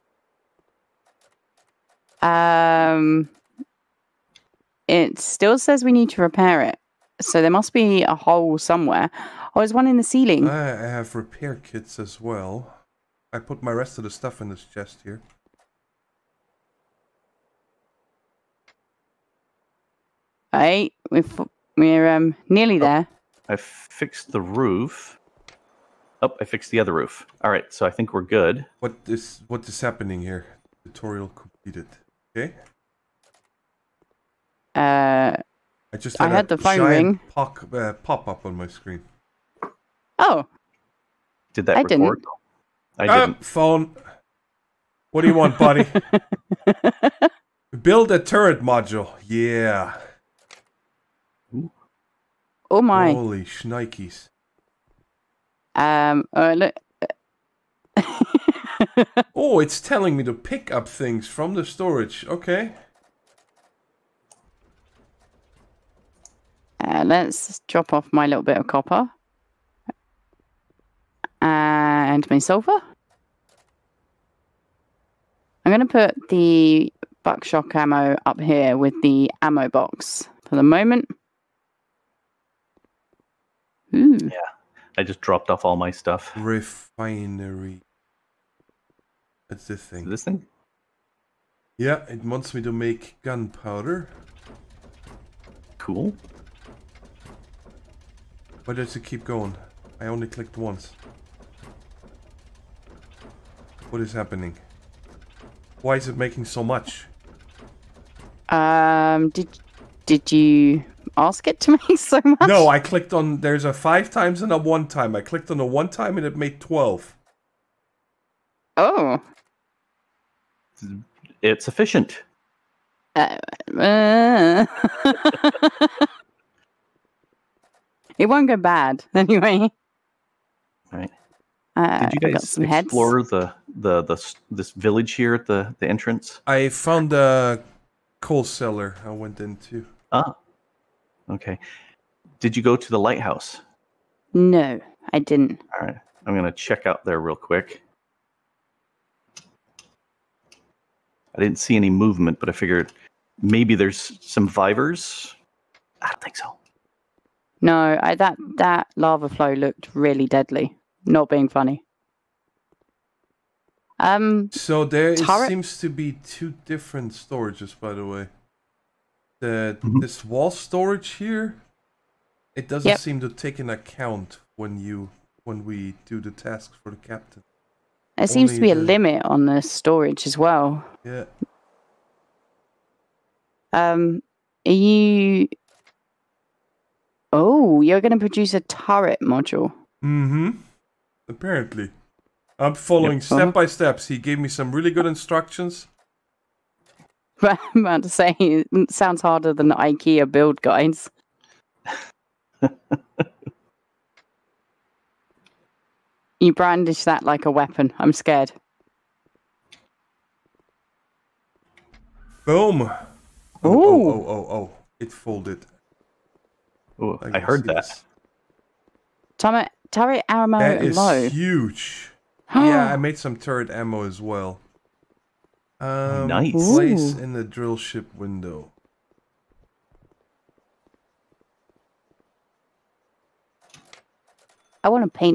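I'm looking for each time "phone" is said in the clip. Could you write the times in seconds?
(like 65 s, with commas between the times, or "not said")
36 s, 43 s.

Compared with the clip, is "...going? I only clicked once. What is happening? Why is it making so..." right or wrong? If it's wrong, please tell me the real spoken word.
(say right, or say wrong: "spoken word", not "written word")
right.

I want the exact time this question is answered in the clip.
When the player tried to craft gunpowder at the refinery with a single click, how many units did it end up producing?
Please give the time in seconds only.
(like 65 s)
116 s.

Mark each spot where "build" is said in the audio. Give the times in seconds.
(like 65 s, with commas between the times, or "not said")
47 s, 200 s.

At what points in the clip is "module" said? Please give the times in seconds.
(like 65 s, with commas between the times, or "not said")
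48 s, 189 s.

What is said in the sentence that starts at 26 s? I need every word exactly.
Oh, I fixed the other roof.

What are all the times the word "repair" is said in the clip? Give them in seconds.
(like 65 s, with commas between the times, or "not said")
6 s, 11 s.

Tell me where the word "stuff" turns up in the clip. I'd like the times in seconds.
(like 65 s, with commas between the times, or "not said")
14 s, 85 s.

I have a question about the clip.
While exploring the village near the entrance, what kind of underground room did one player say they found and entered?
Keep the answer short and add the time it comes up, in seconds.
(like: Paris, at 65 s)
A coal cellar, at 138 s.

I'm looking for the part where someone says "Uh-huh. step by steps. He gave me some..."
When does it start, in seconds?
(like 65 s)
193 s.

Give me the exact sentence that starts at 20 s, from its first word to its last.
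Hey, we're we are um, nearly oh, there.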